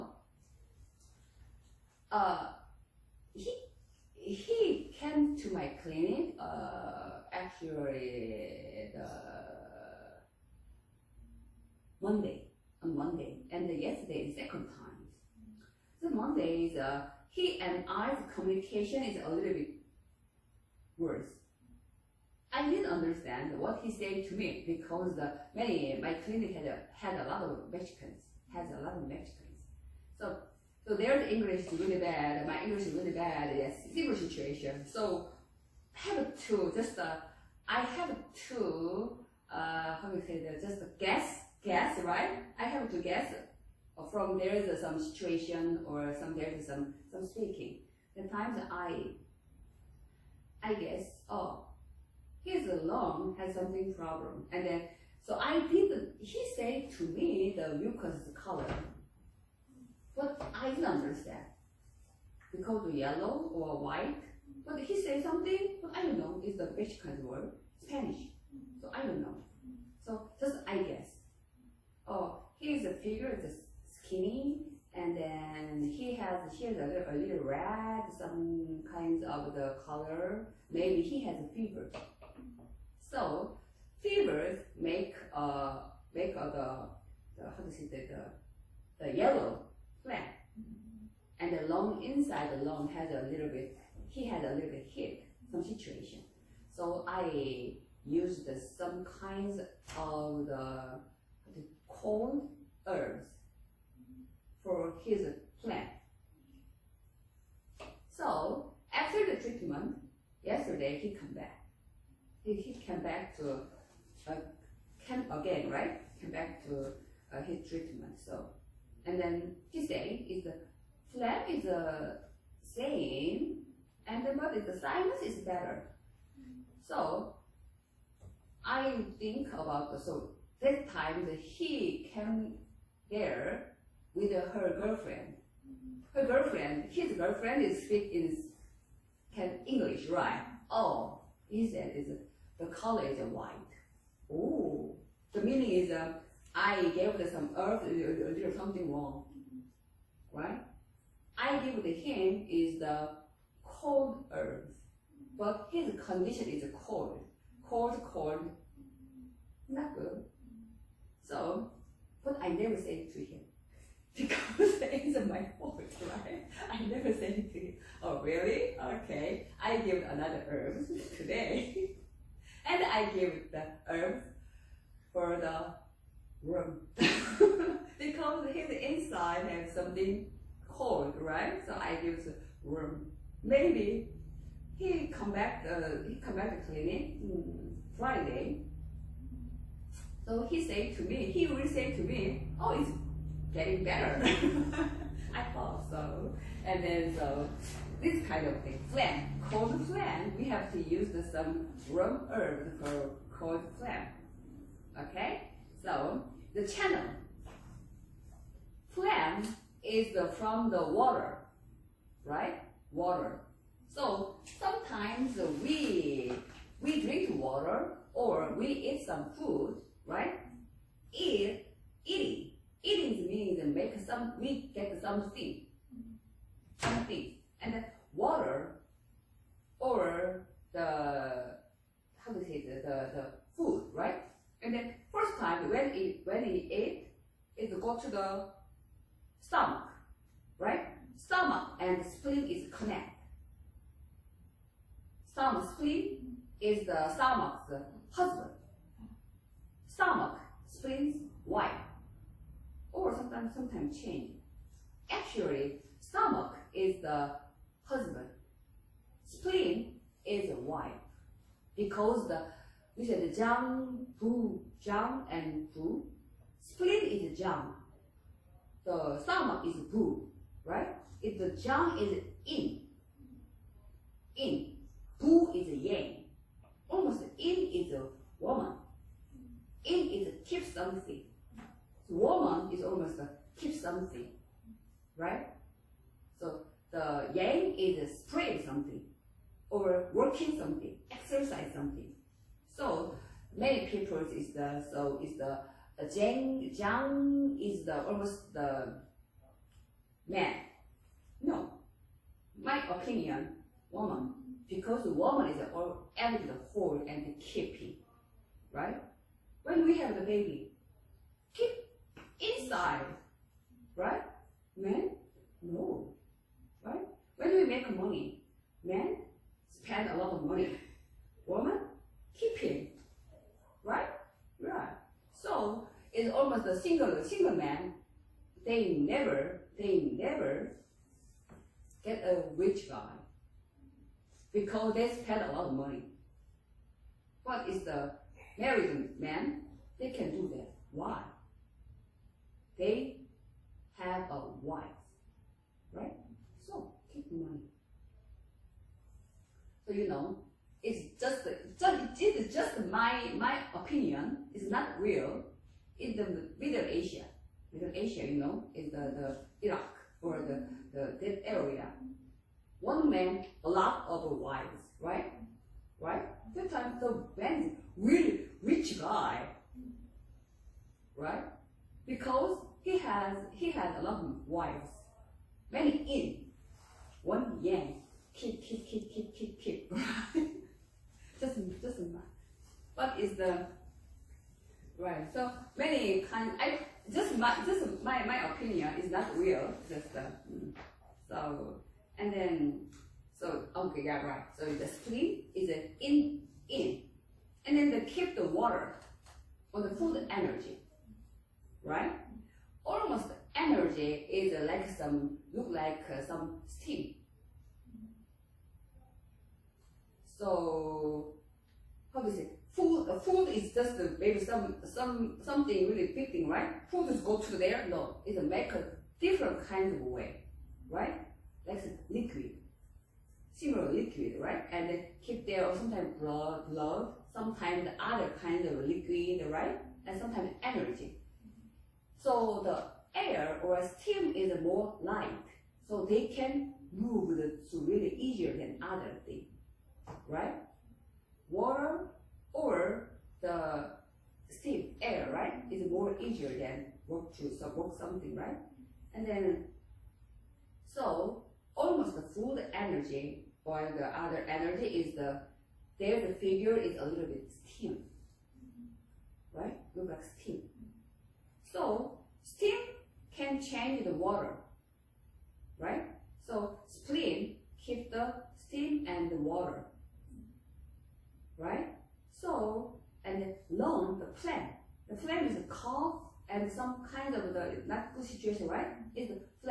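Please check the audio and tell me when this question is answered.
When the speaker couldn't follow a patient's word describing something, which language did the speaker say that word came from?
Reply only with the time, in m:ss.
1:07.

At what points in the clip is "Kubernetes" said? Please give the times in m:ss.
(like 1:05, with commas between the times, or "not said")
not said.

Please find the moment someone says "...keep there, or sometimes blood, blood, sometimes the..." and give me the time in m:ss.
7:05.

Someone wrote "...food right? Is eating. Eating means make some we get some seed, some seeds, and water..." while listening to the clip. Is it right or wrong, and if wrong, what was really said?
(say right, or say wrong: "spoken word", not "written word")
right.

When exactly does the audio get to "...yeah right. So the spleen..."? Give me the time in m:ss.
6:34.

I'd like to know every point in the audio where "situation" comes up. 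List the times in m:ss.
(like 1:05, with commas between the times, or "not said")
0:34, 0:44, 1:35, 7:58.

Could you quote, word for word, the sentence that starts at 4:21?
Because the, we said the Zhang, Bu, Zhang and Bu.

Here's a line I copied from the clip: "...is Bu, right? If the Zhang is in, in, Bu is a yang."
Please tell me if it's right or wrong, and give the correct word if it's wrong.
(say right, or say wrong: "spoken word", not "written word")
right.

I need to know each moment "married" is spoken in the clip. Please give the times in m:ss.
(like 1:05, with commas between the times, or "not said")
5:38.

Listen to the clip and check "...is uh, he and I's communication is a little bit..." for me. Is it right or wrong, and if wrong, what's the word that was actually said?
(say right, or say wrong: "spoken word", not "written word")
right.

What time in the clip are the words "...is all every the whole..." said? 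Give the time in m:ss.
5:05.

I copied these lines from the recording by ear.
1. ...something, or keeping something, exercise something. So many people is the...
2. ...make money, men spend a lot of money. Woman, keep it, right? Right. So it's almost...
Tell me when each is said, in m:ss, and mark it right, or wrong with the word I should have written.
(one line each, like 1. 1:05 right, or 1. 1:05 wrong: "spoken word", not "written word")
1. 4:48 wrong: "working", not "keeping"
2. 5:17 right.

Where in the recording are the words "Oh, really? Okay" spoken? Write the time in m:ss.
2:48.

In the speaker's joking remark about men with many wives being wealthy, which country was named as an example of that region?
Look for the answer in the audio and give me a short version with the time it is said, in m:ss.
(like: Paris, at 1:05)
Iraq, at 5:59.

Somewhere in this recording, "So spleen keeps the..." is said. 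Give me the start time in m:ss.
7:46.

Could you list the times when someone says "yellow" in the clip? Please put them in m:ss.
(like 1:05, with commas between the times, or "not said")
1:02, 1:29.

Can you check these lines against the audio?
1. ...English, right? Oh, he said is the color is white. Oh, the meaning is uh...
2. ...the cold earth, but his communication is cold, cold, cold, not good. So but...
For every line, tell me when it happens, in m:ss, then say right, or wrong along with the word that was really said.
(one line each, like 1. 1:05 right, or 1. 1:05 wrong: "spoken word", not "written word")
1. 2:19 right
2. 2:32 wrong: "condition", not "communication".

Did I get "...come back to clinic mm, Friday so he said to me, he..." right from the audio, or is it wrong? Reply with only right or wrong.
right.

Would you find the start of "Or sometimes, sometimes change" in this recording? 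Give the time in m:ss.
4:12.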